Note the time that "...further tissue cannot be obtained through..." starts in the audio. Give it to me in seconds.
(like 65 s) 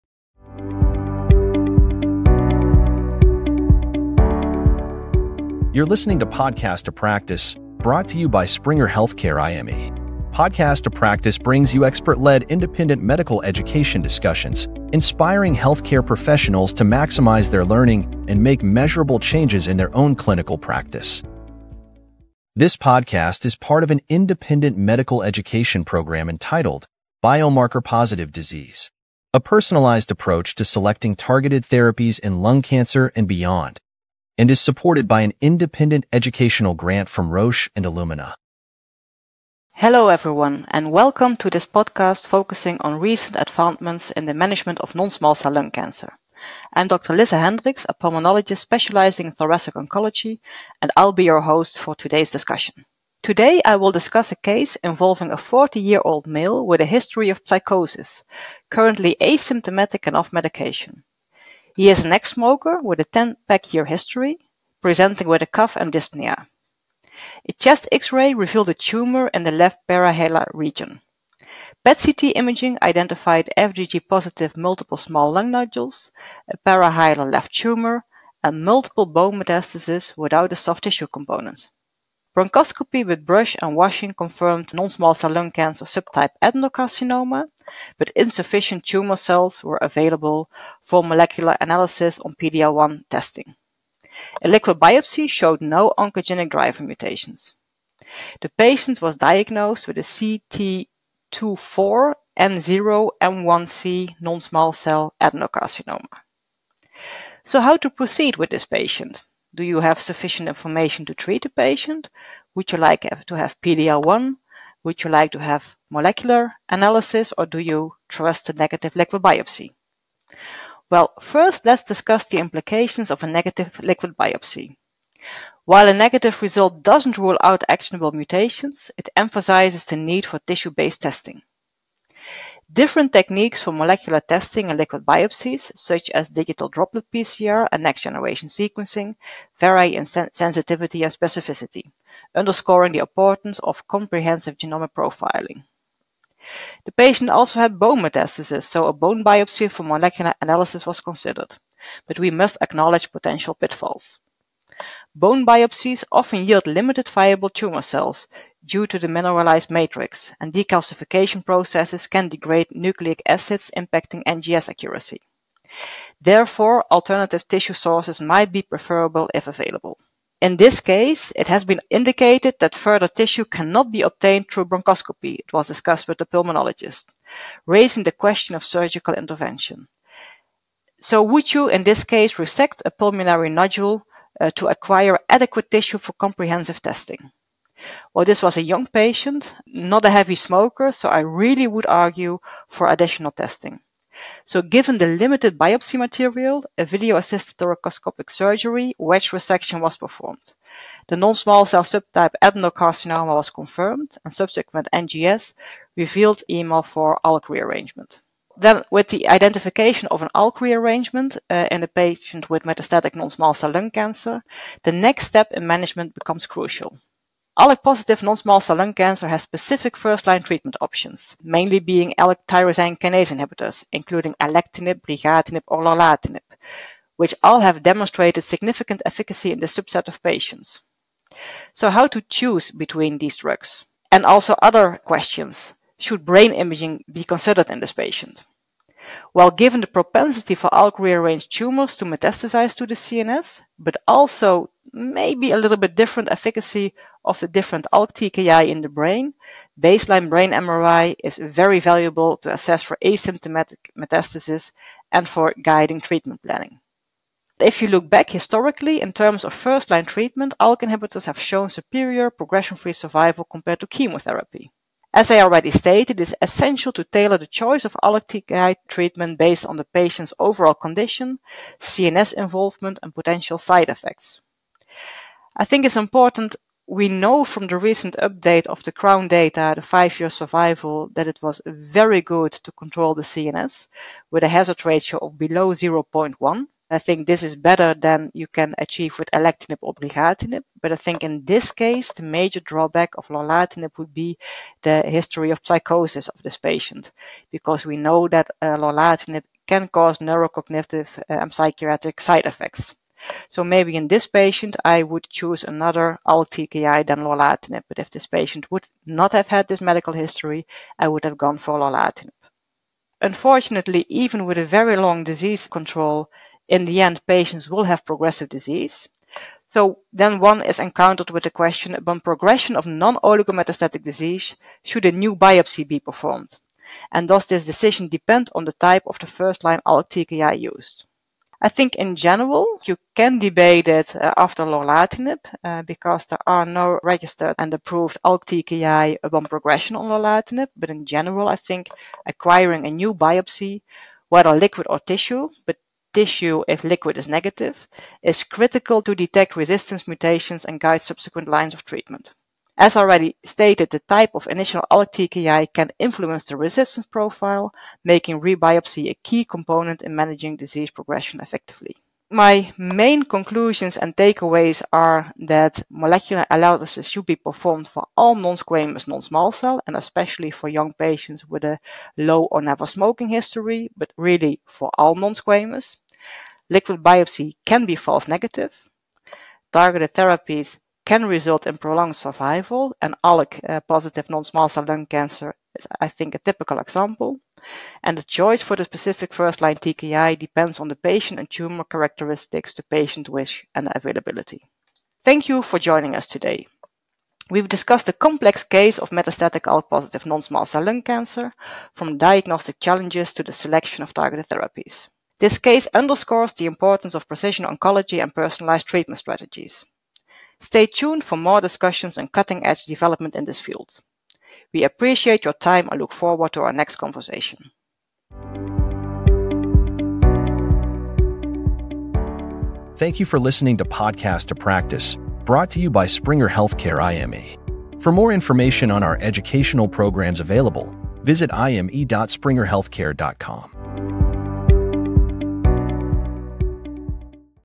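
172 s.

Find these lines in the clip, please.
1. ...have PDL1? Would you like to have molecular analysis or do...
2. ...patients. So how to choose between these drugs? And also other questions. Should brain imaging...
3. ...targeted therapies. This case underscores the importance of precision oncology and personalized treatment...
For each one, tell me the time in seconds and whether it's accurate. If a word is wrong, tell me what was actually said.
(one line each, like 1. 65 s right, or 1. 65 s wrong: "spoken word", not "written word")
1. 113 s right
2. 230 s right
3. 404 s right.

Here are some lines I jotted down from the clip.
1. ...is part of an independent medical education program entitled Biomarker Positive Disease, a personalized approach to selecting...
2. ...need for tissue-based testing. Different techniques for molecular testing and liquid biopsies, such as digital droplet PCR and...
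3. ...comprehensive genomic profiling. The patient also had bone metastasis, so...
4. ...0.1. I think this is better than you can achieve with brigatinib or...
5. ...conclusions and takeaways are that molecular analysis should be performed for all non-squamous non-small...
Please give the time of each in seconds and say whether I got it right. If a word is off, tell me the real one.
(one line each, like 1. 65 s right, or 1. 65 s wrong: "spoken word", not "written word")
1. 23 s right
2. 129 s right
3. 143 s right
4. 285 s wrong: "alectinib", not "brigatinib"
5. 363 s right.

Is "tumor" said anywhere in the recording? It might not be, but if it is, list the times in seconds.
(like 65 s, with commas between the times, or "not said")
68 s, 77 s, 88 s, 157 s, 241 s, 391 s.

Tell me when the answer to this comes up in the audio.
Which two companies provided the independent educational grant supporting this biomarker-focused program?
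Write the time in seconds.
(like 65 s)
37 s.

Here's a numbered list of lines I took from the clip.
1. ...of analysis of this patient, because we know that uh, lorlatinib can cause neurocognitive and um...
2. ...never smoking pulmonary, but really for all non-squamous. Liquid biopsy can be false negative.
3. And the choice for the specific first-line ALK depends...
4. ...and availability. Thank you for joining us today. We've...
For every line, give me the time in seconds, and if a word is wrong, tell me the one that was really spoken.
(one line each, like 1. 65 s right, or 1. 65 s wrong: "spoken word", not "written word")
1. 295 s wrong: "psychosis", not "analysis"
2. 372 s wrong: "history", not "pulmonary"
3. 388 s wrong: "TKI", not "ALK"
4. 393 s right.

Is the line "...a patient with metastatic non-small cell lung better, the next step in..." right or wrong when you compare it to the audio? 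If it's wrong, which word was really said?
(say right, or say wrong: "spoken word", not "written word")
wrong: "cancer", not "better".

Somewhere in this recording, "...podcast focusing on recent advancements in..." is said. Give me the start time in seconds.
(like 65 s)
41 s.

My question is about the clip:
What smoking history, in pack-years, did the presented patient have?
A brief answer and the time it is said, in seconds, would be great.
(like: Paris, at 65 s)
10 pack-years, at 63 s.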